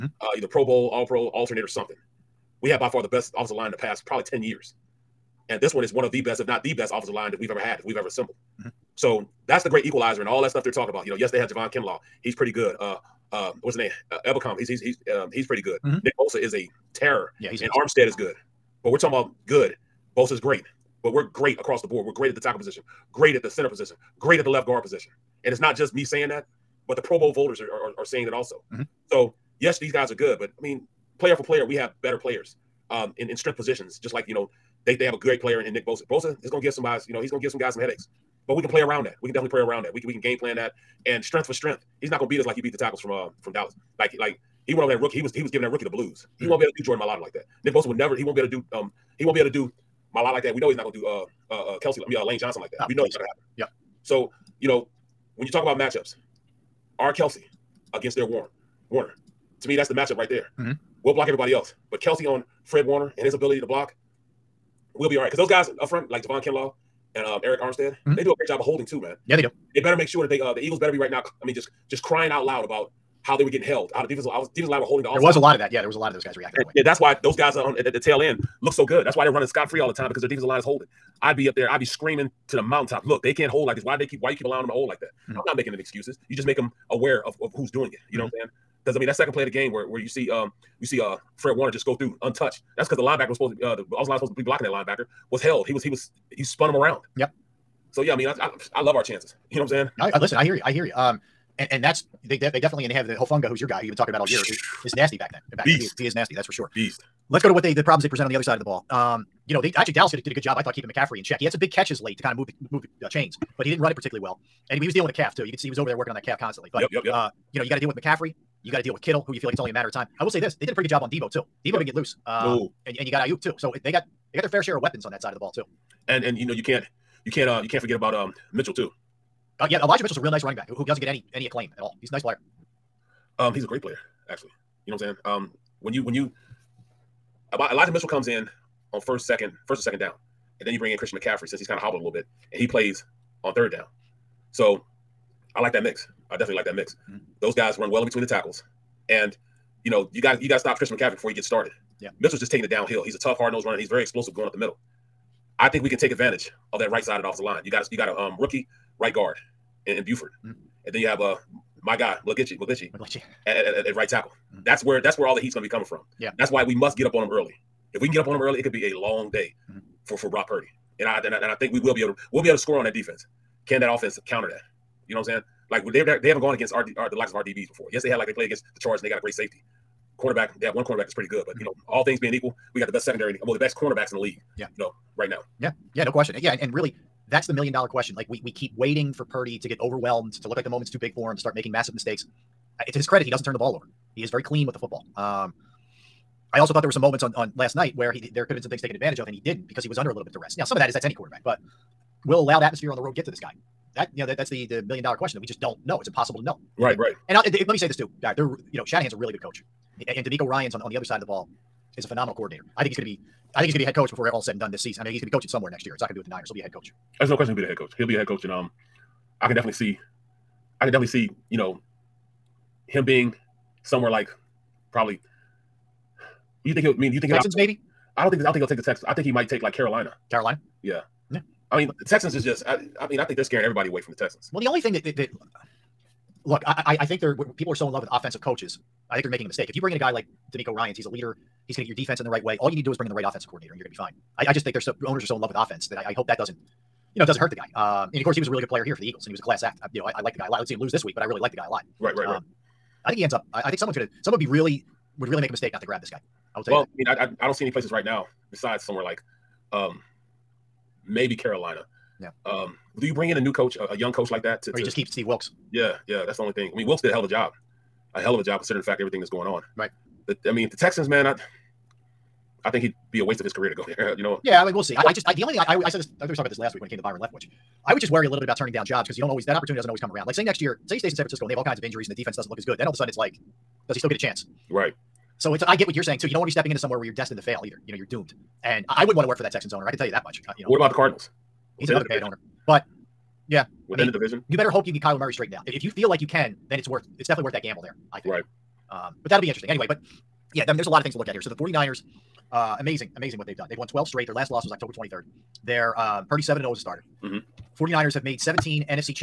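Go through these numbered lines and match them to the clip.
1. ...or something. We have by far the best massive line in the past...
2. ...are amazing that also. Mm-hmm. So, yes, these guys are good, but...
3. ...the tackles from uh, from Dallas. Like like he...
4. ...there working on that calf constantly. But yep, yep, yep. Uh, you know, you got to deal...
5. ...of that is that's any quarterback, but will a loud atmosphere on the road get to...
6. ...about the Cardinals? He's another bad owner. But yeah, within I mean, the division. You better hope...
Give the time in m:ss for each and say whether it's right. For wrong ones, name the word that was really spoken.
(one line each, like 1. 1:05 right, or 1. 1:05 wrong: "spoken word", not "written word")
1. 0:01 wrong: "offensive", not "massive"
2. 0:27 wrong: "saying", not "amazing"
3. 0:42 right
4. 1:55 right
5. 3:20 right
6. 4:50 right.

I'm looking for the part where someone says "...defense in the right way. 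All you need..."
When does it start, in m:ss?
4:01.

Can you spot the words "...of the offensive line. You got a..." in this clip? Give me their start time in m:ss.
2:37.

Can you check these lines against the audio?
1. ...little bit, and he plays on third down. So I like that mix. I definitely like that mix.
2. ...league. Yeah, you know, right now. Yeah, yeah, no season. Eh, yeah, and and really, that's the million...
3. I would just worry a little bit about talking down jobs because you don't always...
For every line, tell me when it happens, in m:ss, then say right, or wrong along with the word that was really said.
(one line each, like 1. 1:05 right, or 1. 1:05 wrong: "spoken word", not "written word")
1. 2:22 right
2. 3:04 wrong: "question", not "season"
3. 4:37 wrong: "turning", not "talking".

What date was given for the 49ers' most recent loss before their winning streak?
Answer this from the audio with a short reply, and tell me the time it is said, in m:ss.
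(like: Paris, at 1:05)
October 23rd, at 5:04.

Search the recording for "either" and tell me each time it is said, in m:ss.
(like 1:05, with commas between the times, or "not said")
0:00, 4:47.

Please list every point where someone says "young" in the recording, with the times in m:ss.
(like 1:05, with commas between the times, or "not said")
4:23.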